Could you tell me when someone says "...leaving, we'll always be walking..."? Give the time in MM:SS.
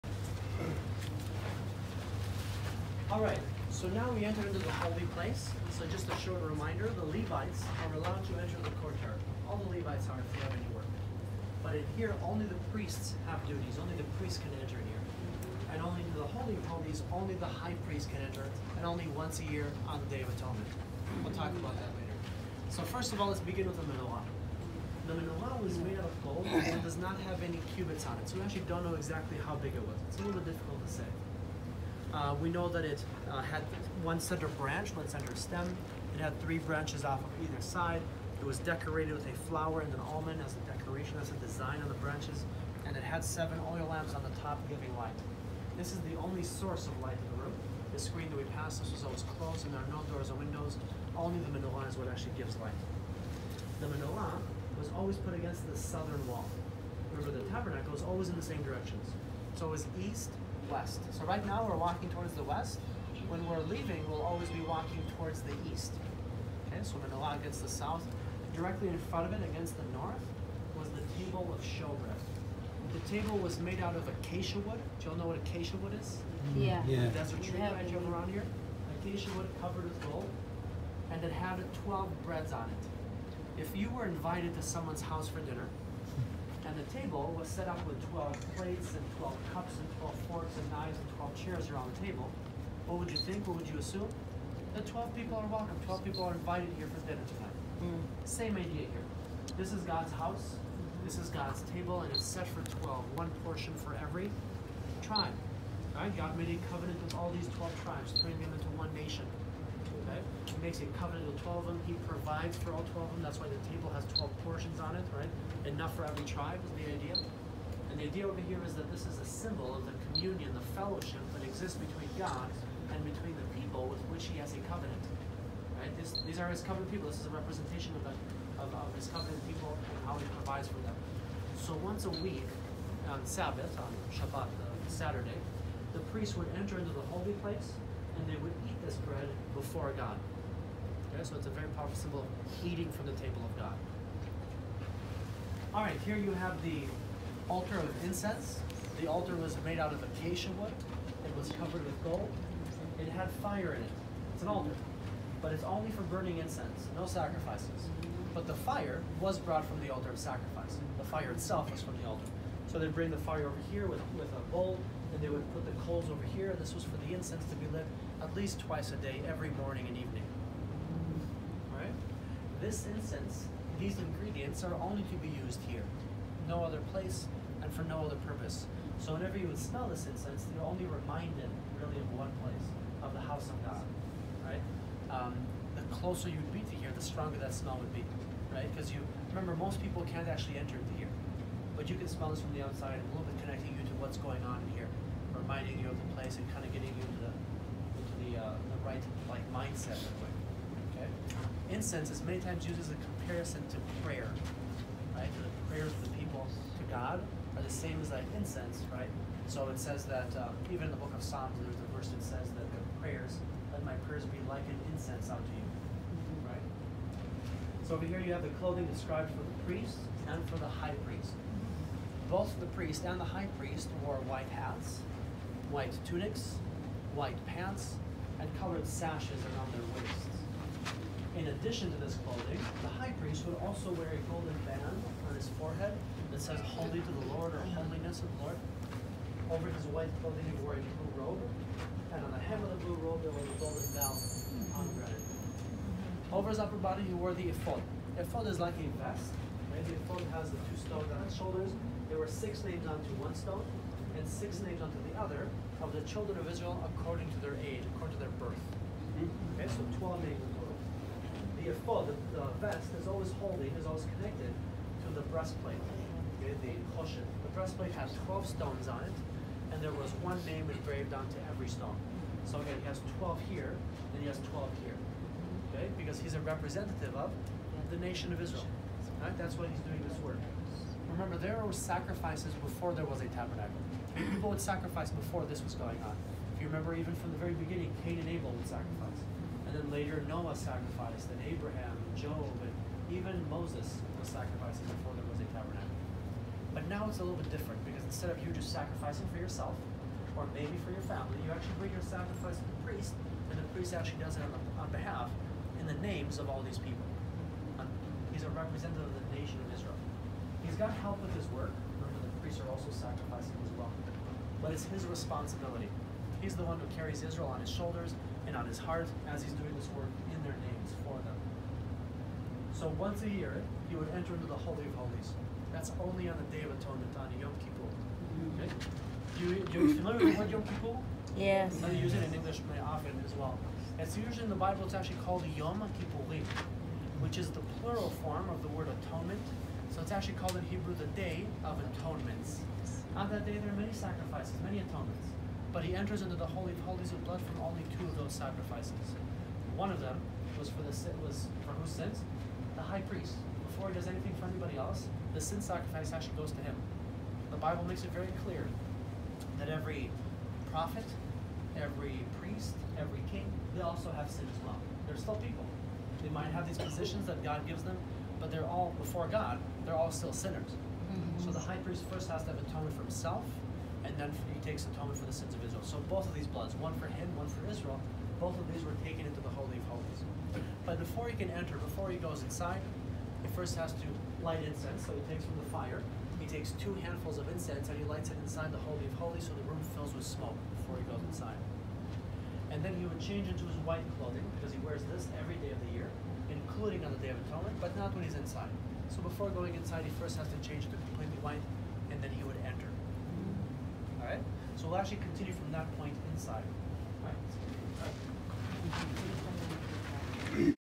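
01:03.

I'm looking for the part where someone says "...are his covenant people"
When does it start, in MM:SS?
02:06.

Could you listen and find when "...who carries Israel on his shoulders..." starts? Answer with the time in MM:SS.
05:16.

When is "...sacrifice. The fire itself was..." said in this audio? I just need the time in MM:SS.
02:40.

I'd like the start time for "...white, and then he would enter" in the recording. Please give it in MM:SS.
06:41.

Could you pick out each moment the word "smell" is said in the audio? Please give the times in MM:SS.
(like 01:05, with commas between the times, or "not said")
02:59, 03:07, 03:12.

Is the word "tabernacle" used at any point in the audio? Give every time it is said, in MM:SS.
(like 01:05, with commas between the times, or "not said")
00:57, 04:43, 04:55.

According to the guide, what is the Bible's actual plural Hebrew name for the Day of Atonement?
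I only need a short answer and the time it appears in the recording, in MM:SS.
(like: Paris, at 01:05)
Yom Kippurim, at 05:35.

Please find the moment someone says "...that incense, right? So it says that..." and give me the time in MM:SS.
03:28.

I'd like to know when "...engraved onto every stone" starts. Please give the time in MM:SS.
04:30.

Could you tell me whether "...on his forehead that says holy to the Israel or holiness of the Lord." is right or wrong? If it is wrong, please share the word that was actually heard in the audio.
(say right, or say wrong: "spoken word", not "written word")
wrong: "Lord", not "Israel".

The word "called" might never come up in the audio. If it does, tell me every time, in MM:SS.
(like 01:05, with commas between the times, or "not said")
05:35, 05:40.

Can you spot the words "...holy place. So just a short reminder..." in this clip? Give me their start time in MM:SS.
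00:04.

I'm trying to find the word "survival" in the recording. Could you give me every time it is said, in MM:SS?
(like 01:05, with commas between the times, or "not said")
not said.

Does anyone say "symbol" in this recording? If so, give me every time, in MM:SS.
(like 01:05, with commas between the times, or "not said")
01:59, 02:21.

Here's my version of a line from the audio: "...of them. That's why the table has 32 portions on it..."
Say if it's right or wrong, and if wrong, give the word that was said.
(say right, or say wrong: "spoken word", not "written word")
wrong: "12", not "32".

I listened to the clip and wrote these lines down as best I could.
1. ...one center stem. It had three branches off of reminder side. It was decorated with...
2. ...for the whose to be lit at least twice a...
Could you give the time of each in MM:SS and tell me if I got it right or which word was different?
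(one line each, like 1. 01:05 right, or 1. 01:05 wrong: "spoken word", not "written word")
1. 00:34 wrong: "either", not "reminder"
2. 02:46 wrong: "incense", not "whose".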